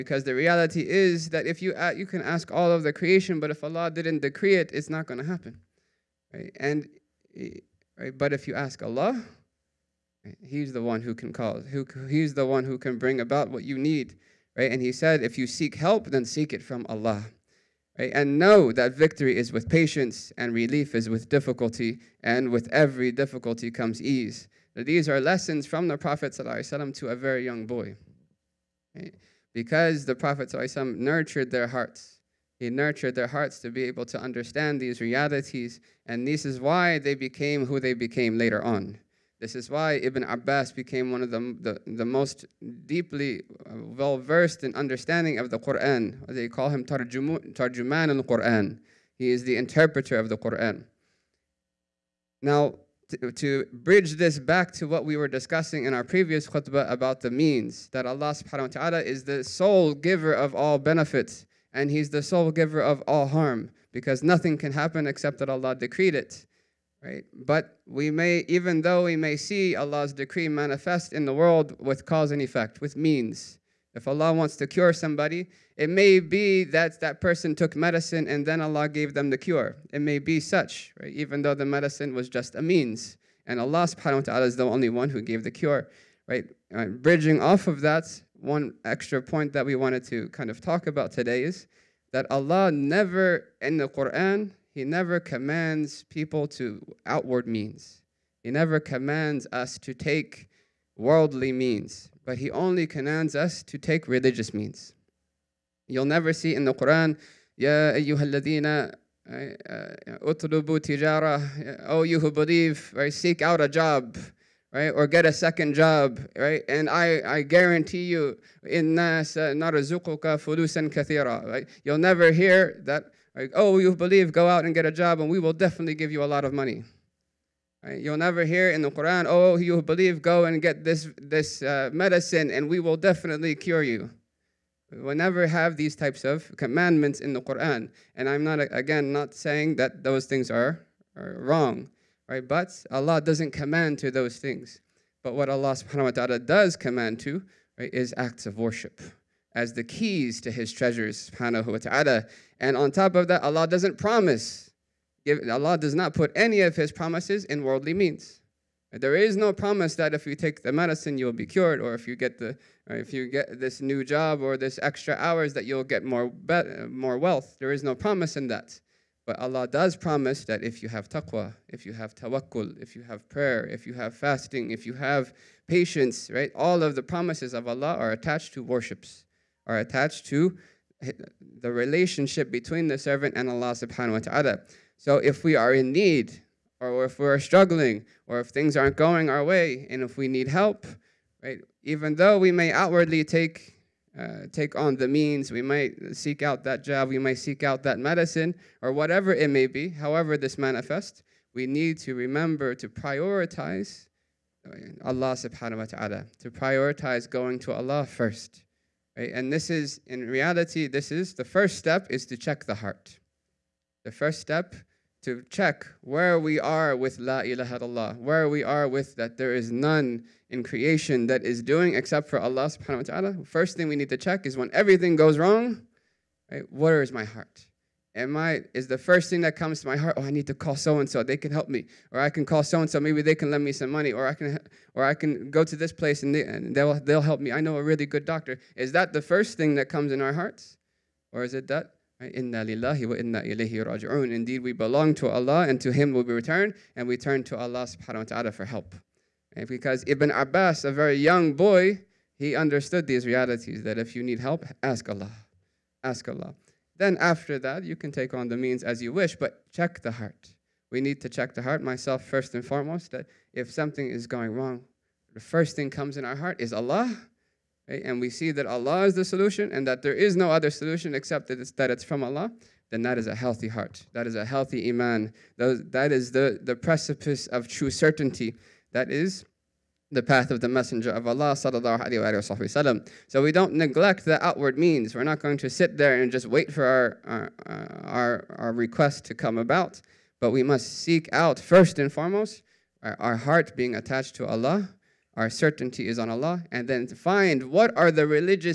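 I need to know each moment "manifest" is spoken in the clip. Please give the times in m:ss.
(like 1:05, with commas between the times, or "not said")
1:10, 3:20.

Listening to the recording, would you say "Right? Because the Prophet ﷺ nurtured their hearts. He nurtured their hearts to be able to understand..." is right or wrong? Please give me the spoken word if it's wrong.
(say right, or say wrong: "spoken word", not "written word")
right.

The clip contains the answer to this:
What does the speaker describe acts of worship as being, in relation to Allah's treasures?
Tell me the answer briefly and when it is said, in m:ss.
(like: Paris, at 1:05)
the keys, at 2:29.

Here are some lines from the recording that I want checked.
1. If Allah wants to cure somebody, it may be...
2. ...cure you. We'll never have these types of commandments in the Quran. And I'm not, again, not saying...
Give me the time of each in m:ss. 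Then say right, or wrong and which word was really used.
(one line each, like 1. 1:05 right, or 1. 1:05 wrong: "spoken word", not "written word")
1. 1:13 right
2. 2:13 right.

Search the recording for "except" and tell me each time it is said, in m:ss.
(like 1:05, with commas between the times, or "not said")
1:05, 3:41, 4:31.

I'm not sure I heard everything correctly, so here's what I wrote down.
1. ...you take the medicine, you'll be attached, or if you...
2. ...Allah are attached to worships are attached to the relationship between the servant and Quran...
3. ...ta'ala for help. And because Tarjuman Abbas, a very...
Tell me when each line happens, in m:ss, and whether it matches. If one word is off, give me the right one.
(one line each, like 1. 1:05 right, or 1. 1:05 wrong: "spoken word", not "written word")
1. 2:40 wrong: "cured", not "attached"
2. 2:57 wrong: "Allah", not "Quran"
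3. 4:08 wrong: "Ibn", not "Tarjuman".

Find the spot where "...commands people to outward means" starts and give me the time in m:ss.
1:35.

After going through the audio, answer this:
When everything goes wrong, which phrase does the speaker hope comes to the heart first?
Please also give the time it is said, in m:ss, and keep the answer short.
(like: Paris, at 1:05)
Inna lillahi wa inna ilayhi raji'un, at 4:02.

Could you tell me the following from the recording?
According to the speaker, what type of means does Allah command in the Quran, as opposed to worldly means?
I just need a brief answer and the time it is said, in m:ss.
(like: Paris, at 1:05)
religious means, at 1:44.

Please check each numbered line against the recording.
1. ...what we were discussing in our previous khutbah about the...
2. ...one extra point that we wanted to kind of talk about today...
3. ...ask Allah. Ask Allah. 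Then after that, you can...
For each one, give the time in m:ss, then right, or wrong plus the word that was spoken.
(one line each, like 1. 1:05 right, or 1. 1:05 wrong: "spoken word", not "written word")
1. 0:54 right
2. 1:28 right
3. 4:14 right.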